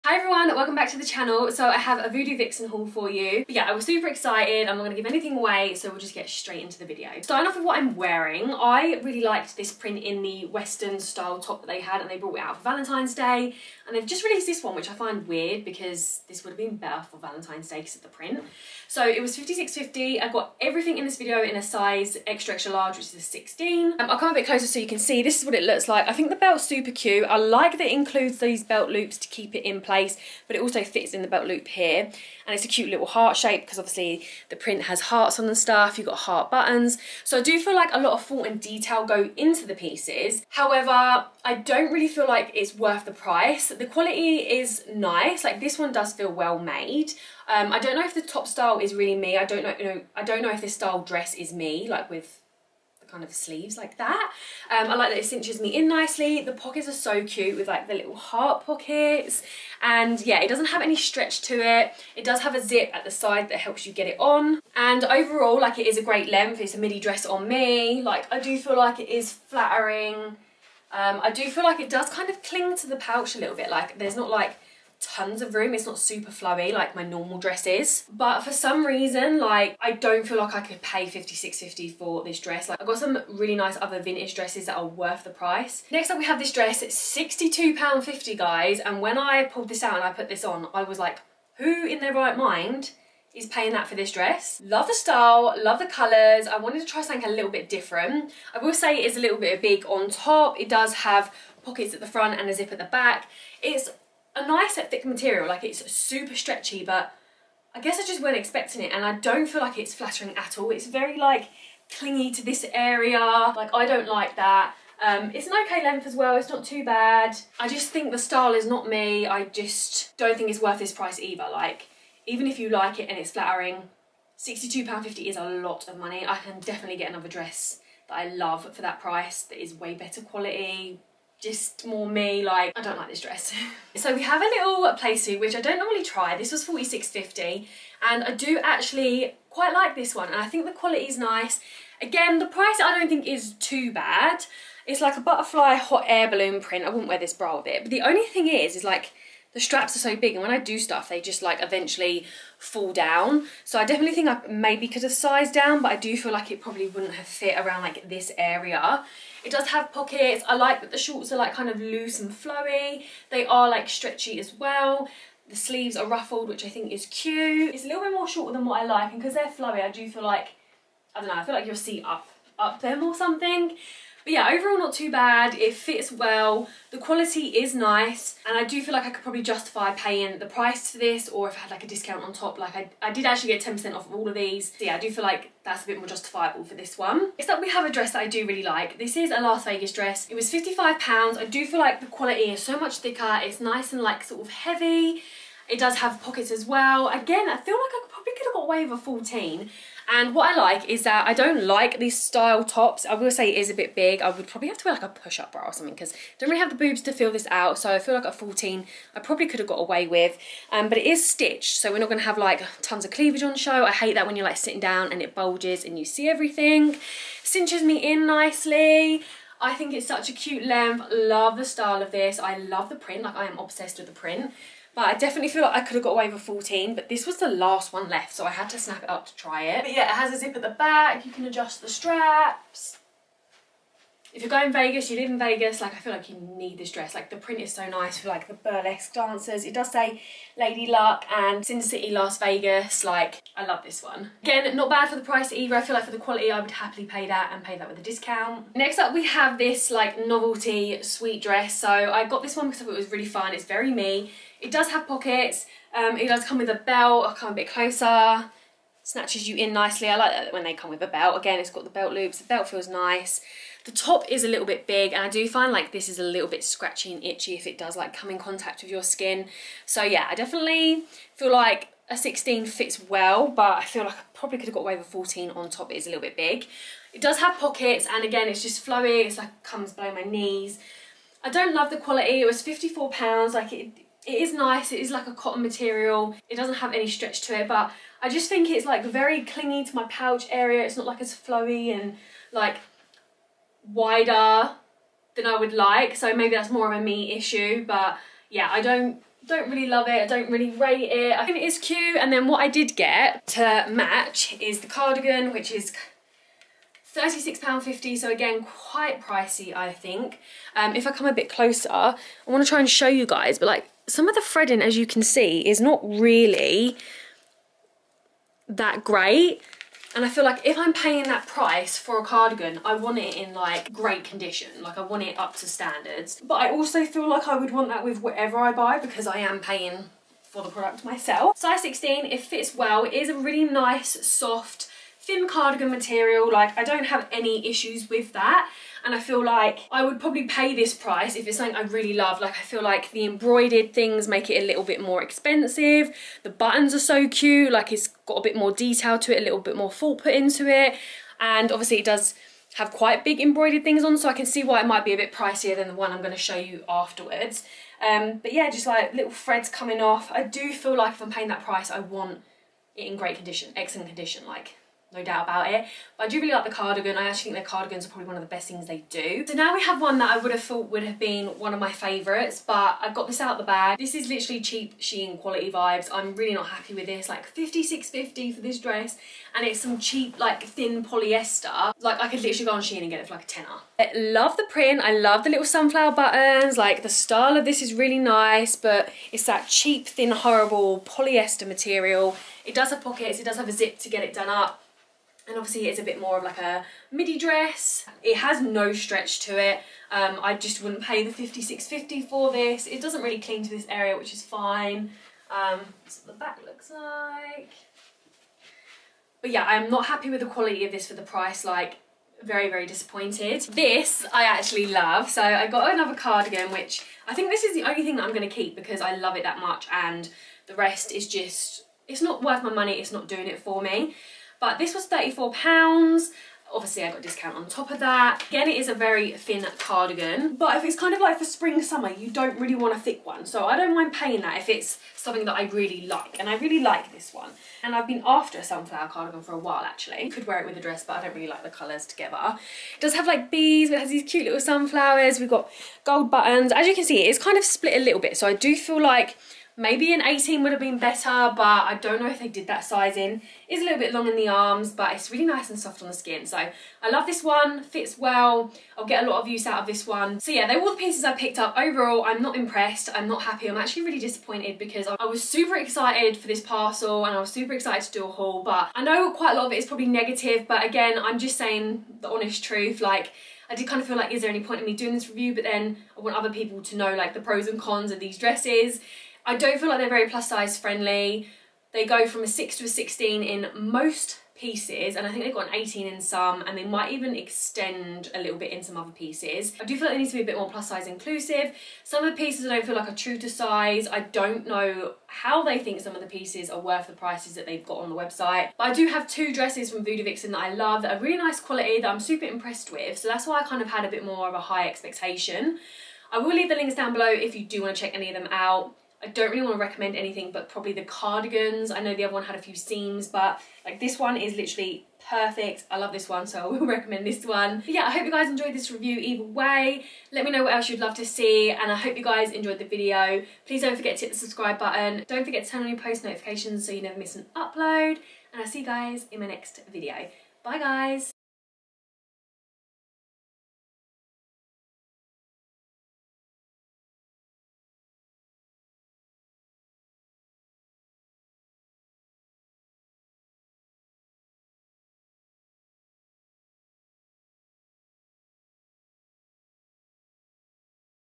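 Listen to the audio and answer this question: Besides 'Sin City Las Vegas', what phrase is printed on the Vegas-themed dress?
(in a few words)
Lady Luck.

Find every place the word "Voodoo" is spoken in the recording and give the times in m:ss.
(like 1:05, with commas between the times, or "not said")
0:02, 8:20.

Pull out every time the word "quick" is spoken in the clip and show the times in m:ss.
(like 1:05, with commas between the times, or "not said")
not said.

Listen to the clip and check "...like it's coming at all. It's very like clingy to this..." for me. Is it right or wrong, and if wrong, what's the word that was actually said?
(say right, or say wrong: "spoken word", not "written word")
wrong: "flattering", not "coming".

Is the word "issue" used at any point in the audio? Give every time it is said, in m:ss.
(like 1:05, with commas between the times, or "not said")
4:57, 5:37.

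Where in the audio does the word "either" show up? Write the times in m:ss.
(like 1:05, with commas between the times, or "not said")
2:01, 4:05, 8:39.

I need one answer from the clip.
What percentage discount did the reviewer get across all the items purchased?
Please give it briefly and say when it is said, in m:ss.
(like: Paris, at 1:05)
10%, at 3:03.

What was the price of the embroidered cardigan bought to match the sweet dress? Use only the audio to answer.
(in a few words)
£36.50.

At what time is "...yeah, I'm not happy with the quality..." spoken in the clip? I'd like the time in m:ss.
6:49.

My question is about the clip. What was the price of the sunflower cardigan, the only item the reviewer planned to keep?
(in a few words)
£34.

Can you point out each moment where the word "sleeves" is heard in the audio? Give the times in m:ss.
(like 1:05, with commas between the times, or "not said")
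0:53, 2:45.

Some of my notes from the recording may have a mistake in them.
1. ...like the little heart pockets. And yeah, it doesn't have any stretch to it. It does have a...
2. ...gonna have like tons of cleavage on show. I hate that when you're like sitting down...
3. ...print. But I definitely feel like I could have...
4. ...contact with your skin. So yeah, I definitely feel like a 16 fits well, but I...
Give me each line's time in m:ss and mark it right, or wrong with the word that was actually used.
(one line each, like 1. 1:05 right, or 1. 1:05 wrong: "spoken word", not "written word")
1. 0:57 right
2. 3:32 right
3. 3:44 right
4. 4:28 right.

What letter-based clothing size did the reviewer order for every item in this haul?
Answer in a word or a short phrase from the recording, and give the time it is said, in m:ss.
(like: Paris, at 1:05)
extra extra large, at 0:22.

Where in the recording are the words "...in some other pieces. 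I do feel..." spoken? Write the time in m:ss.
8:08.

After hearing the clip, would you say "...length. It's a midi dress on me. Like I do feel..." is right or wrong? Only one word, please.
right.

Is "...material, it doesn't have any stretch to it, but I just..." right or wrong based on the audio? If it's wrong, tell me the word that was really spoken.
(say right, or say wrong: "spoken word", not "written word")
right.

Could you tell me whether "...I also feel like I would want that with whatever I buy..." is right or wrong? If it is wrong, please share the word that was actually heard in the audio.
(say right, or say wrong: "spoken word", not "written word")
right.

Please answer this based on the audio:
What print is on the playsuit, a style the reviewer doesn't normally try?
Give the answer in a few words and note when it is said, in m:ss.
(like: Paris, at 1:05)
butterfly hot air balloon, at 2:25.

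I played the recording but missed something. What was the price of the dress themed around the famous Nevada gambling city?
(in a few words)
£55.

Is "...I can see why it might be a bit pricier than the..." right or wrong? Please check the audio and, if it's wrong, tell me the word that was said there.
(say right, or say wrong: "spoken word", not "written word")
right.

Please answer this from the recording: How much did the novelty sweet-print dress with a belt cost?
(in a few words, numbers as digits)
£54.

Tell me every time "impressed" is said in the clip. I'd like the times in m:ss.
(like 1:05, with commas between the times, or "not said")
7:42, 8:22.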